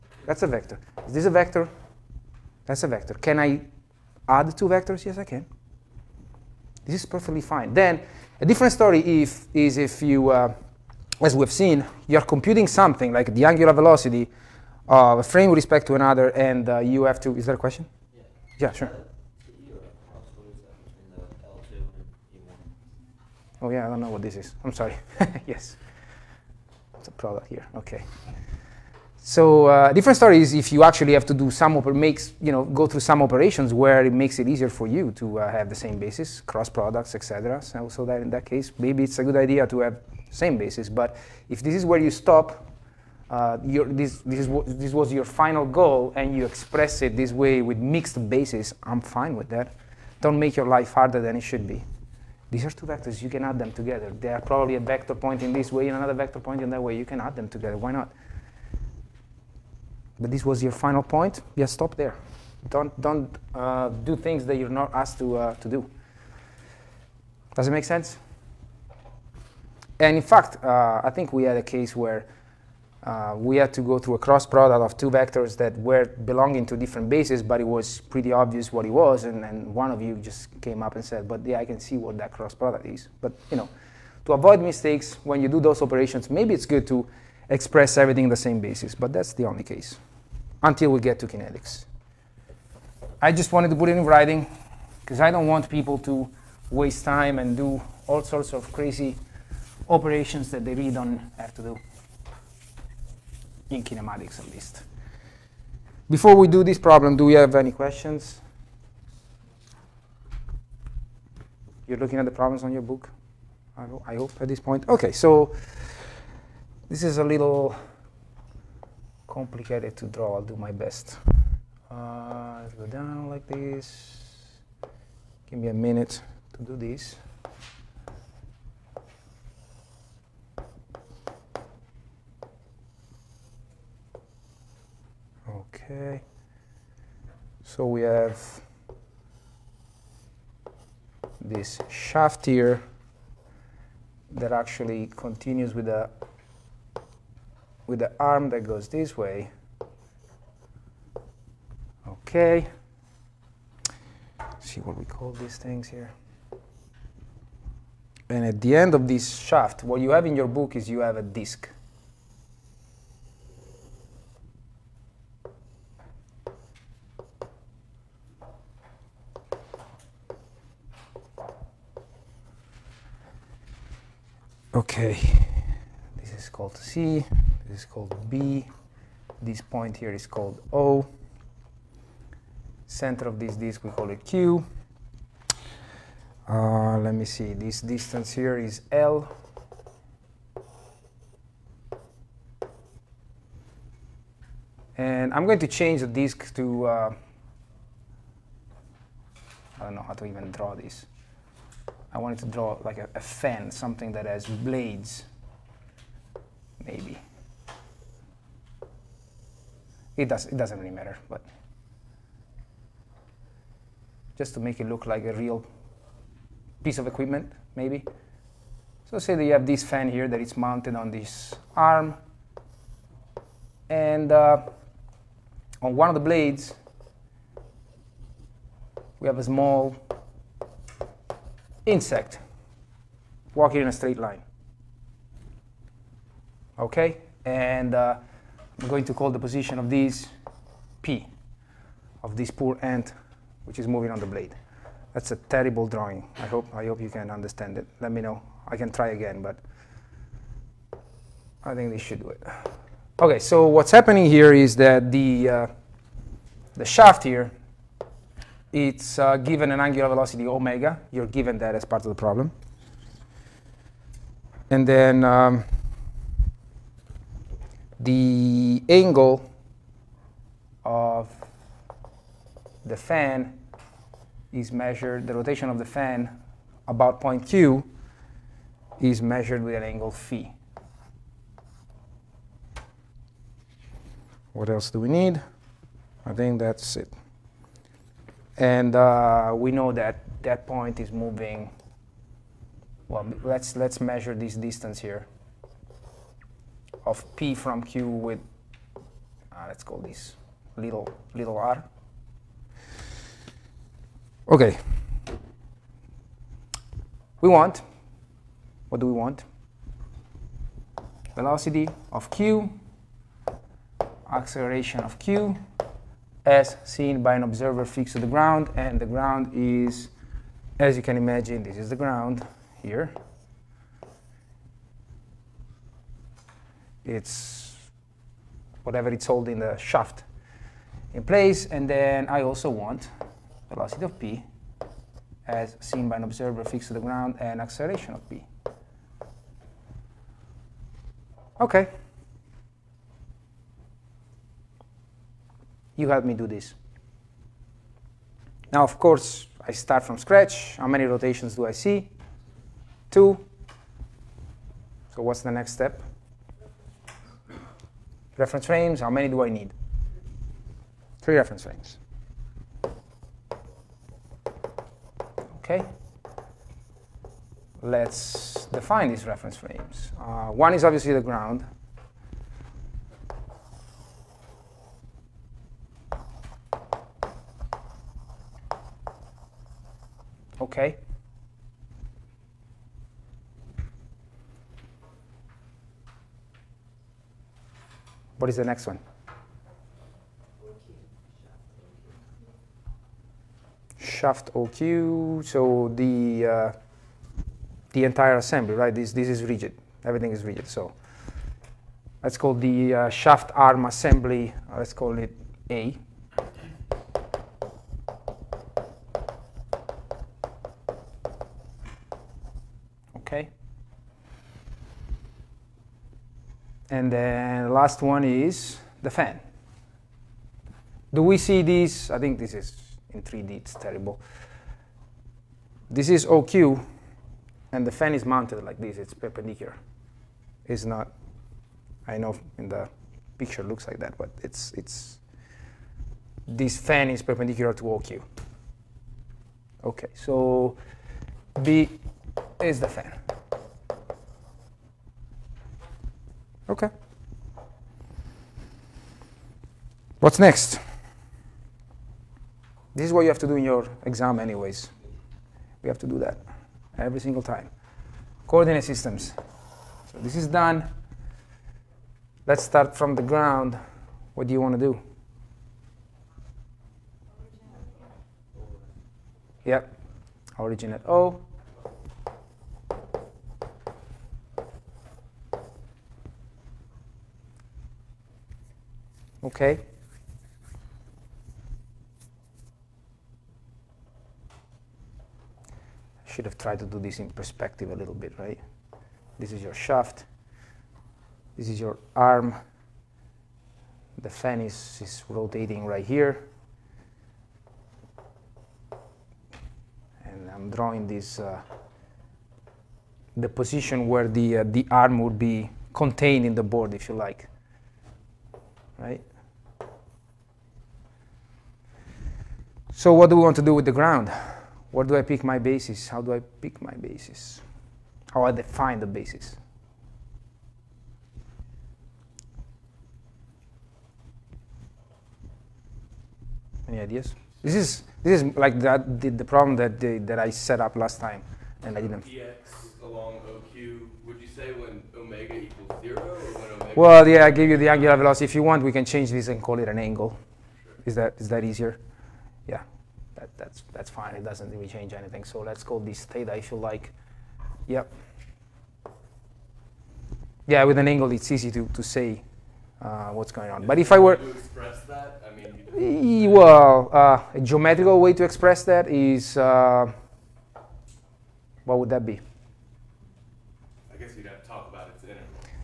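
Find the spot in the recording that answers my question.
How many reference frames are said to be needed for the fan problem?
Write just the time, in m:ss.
6:01.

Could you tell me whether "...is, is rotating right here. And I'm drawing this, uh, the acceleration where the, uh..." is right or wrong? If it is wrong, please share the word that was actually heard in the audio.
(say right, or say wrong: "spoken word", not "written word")
wrong: "position", not "acceleration".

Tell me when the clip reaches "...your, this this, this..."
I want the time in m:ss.
0:43.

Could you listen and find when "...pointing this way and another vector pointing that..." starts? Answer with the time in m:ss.
0:55.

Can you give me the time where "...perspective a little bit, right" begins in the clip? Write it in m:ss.
8:07.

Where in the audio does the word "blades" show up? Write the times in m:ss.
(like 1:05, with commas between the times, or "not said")
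3:24, 3:46, 4:04.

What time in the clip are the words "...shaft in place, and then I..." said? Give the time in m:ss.
5:29.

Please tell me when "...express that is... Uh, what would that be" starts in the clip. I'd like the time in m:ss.
9:18.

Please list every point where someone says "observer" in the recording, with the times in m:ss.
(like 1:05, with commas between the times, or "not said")
5:17, 5:36.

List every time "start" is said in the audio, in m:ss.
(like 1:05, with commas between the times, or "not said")
5:49, 7:42.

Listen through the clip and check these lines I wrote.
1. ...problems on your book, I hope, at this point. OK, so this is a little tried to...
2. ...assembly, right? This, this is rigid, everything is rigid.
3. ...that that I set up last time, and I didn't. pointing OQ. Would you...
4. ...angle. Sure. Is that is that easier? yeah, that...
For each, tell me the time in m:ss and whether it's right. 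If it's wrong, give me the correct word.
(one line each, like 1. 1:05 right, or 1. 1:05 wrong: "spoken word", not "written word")
1. 1:52 wrong: "complicated", not "tried"
2. 6:38 right
3. 8:49 wrong: "along", not "pointing"
4. 8:59 right.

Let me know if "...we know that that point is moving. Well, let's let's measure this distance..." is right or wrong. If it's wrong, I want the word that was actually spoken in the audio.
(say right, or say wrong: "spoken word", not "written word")
right.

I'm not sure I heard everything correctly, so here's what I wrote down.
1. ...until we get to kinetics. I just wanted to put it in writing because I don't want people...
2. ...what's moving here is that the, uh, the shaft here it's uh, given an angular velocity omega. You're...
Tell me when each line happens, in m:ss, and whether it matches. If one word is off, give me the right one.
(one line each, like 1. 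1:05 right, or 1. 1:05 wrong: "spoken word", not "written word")
1. 1:30 right
2. 4:13 wrong: "happening", not "moving".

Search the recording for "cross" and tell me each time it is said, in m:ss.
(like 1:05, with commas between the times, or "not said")
0:36, 1:14, 1:22.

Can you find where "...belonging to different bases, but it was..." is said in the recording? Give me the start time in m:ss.
1:16.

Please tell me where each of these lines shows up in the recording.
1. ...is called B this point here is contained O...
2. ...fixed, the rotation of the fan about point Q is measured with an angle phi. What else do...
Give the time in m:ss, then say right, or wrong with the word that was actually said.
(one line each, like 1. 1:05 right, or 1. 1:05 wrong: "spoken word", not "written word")
1. 2:57 wrong: "called", not "contained"
2. 4:34 wrong: "measured", not "fixed".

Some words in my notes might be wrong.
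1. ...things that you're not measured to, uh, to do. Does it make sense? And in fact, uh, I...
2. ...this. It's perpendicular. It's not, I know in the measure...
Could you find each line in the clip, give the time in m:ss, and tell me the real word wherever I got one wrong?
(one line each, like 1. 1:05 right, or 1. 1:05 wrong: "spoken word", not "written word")
1. 1:04 wrong: "asked", not "measured"
2. 7:08 wrong: "picture", not "measure".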